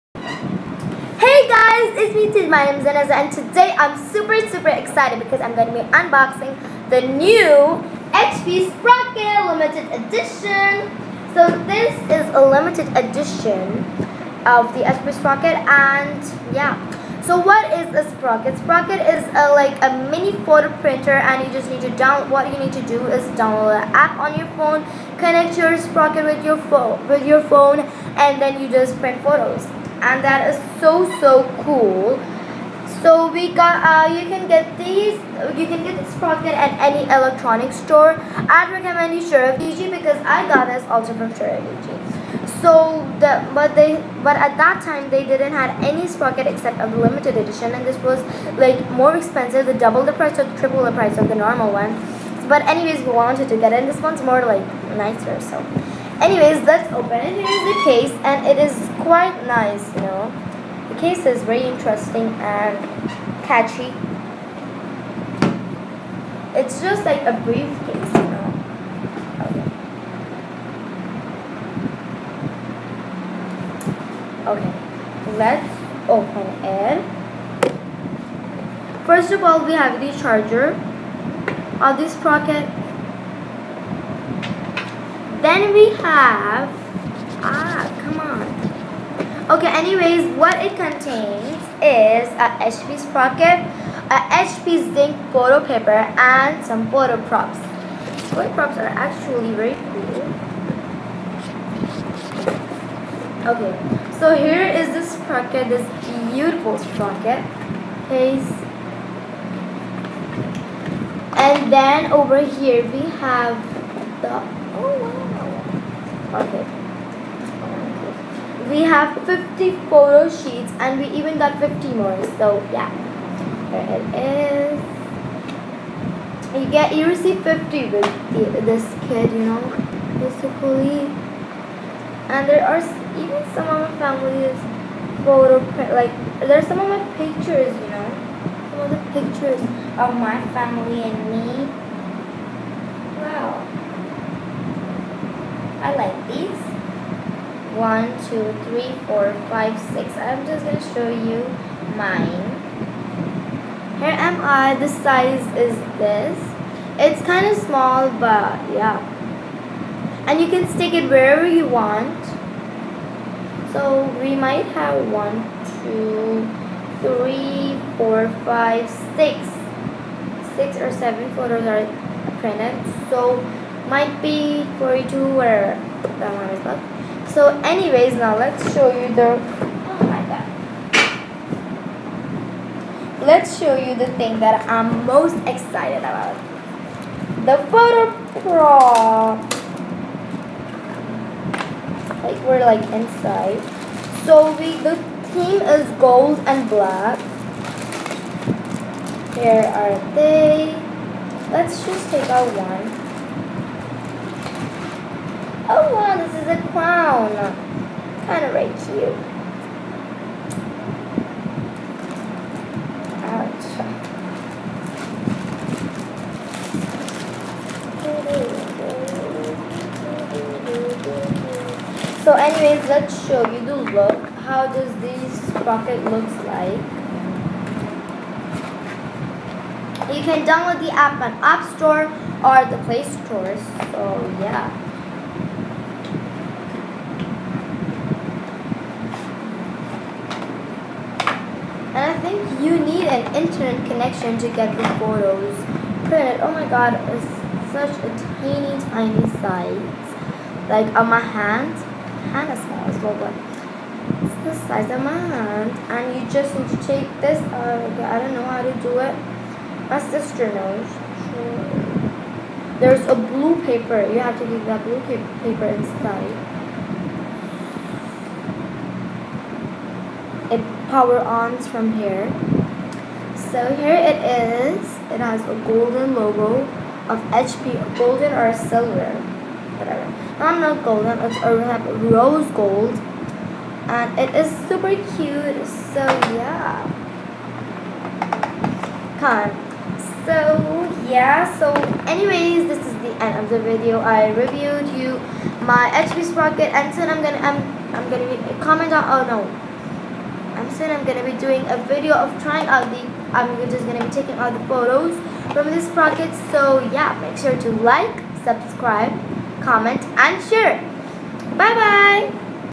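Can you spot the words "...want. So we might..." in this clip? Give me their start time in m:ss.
2:41.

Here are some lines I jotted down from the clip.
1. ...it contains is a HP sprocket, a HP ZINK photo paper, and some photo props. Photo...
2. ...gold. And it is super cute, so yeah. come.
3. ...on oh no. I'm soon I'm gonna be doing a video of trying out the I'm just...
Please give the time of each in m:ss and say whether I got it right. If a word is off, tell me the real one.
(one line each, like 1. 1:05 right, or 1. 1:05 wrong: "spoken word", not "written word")
1. 1:30 right
2. 4:42 right
3. 4:58 right.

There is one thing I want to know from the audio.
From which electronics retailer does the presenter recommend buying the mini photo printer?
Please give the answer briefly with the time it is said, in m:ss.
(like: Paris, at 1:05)
Sharaf DG, at 0:39.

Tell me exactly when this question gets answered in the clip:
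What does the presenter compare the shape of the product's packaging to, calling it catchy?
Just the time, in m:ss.
1:07.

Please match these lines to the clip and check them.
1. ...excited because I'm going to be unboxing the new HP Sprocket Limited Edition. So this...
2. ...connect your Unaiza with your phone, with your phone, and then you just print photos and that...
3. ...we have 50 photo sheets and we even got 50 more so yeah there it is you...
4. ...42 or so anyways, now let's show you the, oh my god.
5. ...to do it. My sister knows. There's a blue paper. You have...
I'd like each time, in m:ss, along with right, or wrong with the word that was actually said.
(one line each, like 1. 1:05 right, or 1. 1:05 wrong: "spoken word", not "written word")
1. 0:04 right
2. 0:25 wrong: "Sprocket", not "Unaiza"
3. 1:58 right
4. 2:54 right
5. 4:18 right.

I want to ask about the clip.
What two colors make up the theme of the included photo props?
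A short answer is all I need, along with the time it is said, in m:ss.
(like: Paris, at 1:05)
Gold and black, at 3:16.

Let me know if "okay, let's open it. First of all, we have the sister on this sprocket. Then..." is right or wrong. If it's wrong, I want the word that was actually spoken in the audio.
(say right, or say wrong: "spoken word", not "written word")
wrong: "charger", not "sister".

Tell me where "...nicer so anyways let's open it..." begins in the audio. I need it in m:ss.
0:55.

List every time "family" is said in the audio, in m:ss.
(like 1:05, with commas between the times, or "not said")
2:13, 2:20.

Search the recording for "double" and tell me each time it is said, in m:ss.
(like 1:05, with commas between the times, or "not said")
0:49.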